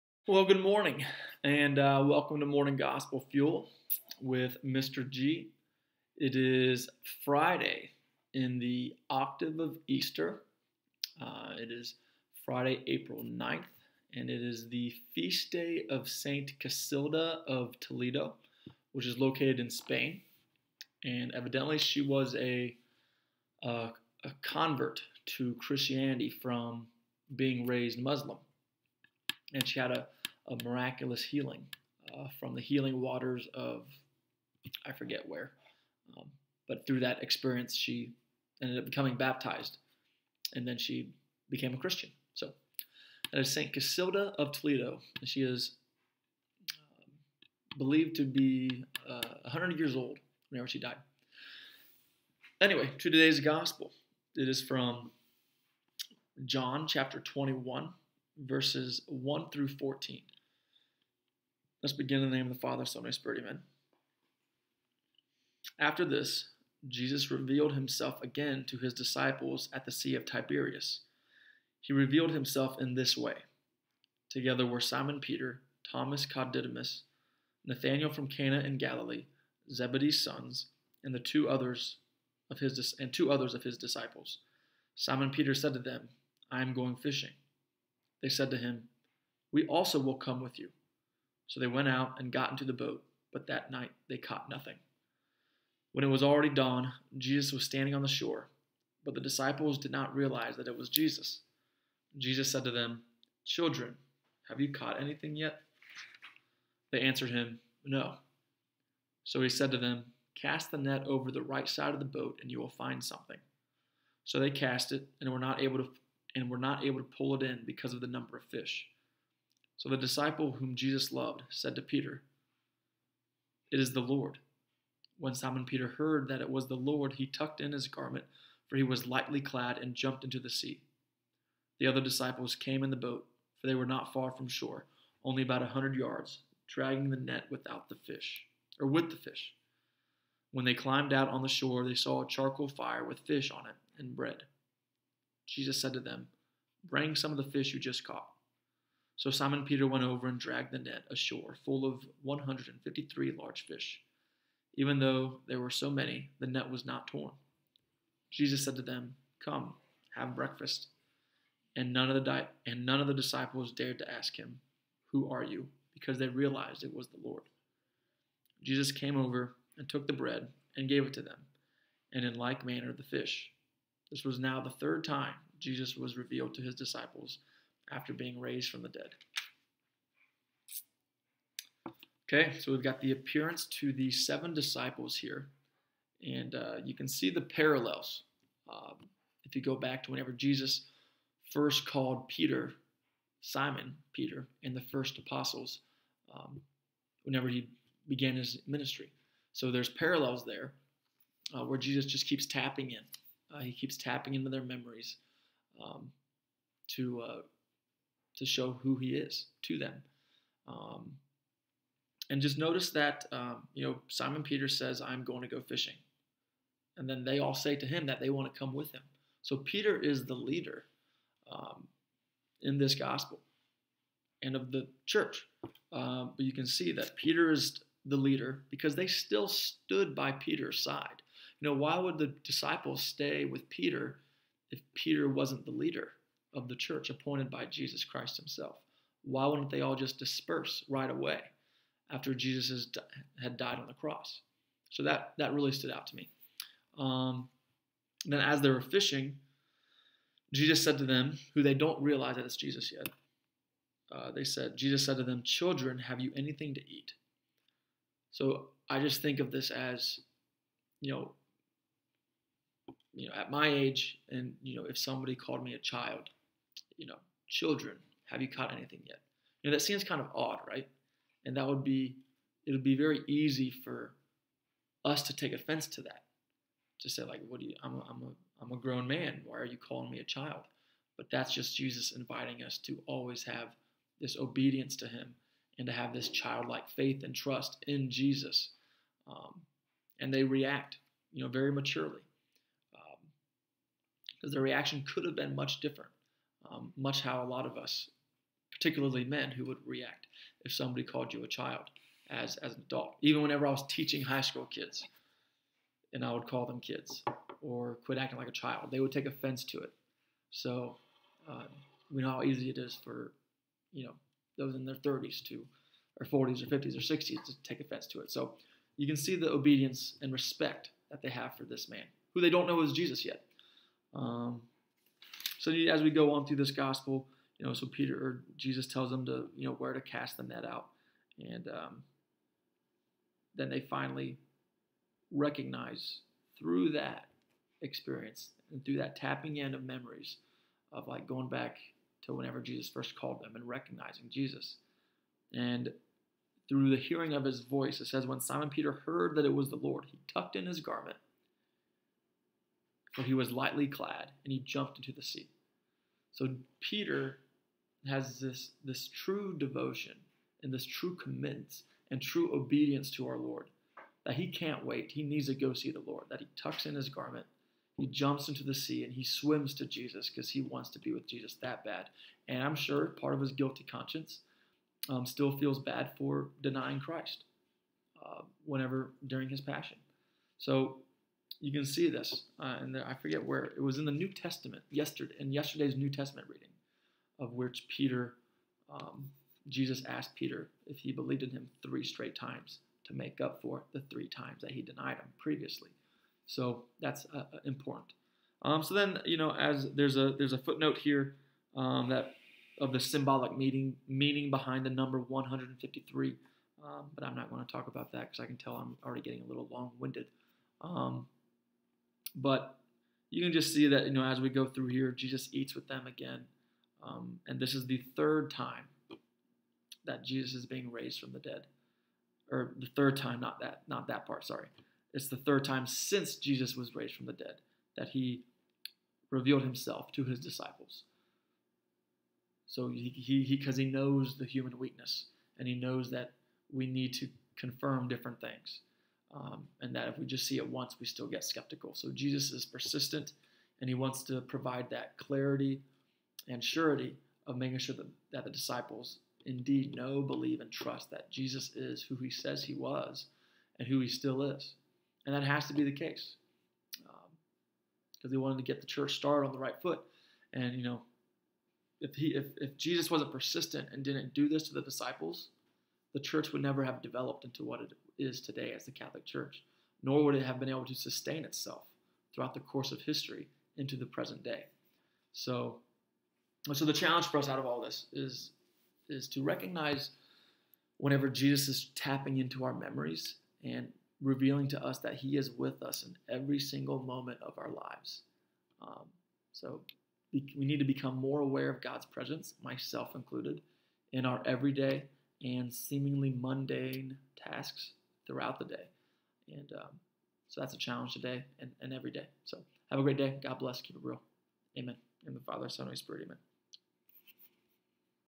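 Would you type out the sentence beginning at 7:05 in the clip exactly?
It's the third time since Jesus was raised from the dead that he revealed himself to his disciples.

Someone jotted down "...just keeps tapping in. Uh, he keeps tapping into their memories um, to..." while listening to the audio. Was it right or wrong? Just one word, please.
right.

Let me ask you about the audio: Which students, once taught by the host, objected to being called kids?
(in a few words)
high school kids.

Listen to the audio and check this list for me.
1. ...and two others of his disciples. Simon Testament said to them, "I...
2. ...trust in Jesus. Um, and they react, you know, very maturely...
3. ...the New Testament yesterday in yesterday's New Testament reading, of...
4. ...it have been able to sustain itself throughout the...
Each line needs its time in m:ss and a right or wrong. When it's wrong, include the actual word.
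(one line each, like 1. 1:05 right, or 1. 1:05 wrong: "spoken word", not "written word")
1. 1:22 wrong: "Peter", not "Testament"
2. 4:47 right
3. 6:24 right
4. 7:50 right.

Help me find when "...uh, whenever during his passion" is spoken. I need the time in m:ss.
6:18.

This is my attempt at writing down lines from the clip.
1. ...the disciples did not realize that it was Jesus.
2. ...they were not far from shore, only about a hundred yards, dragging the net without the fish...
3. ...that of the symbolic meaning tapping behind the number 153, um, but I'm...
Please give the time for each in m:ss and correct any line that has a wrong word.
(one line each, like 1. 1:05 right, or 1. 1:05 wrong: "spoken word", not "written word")
1. 1:39 right
2. 2:13 right
3. 6:42 wrong: "meaning", not "tapping".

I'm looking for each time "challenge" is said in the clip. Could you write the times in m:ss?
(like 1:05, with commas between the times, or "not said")
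7:56, 8:20.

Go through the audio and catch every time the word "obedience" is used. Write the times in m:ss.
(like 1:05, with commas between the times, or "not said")
4:44, 5:19, 6:02.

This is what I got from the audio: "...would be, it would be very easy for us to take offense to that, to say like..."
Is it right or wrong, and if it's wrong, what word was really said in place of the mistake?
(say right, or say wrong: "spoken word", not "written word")
right.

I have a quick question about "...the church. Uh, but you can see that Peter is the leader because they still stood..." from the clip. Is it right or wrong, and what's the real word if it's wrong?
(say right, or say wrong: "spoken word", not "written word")
right.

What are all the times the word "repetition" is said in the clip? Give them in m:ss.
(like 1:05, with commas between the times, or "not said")
not said.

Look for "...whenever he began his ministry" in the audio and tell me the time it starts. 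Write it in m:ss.
3:17.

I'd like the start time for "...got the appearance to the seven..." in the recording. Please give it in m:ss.
3:02.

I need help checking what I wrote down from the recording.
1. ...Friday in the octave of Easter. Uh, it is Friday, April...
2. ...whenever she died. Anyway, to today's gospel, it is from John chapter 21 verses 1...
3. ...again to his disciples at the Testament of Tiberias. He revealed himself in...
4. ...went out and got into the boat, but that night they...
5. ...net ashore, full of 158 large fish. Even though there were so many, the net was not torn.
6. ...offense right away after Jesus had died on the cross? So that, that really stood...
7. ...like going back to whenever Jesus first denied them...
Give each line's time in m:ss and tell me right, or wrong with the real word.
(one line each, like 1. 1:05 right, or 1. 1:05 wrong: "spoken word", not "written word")
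1. 0:07 right
2. 0:50 right
3. 1:08 wrong: "Sea", not "Testament"
4. 1:31 right
5. 2:30 wrong: "153", not "158"
6. 4:00 wrong: "disperse", not "offense"
7. 5:41 wrong: "called", not "denied".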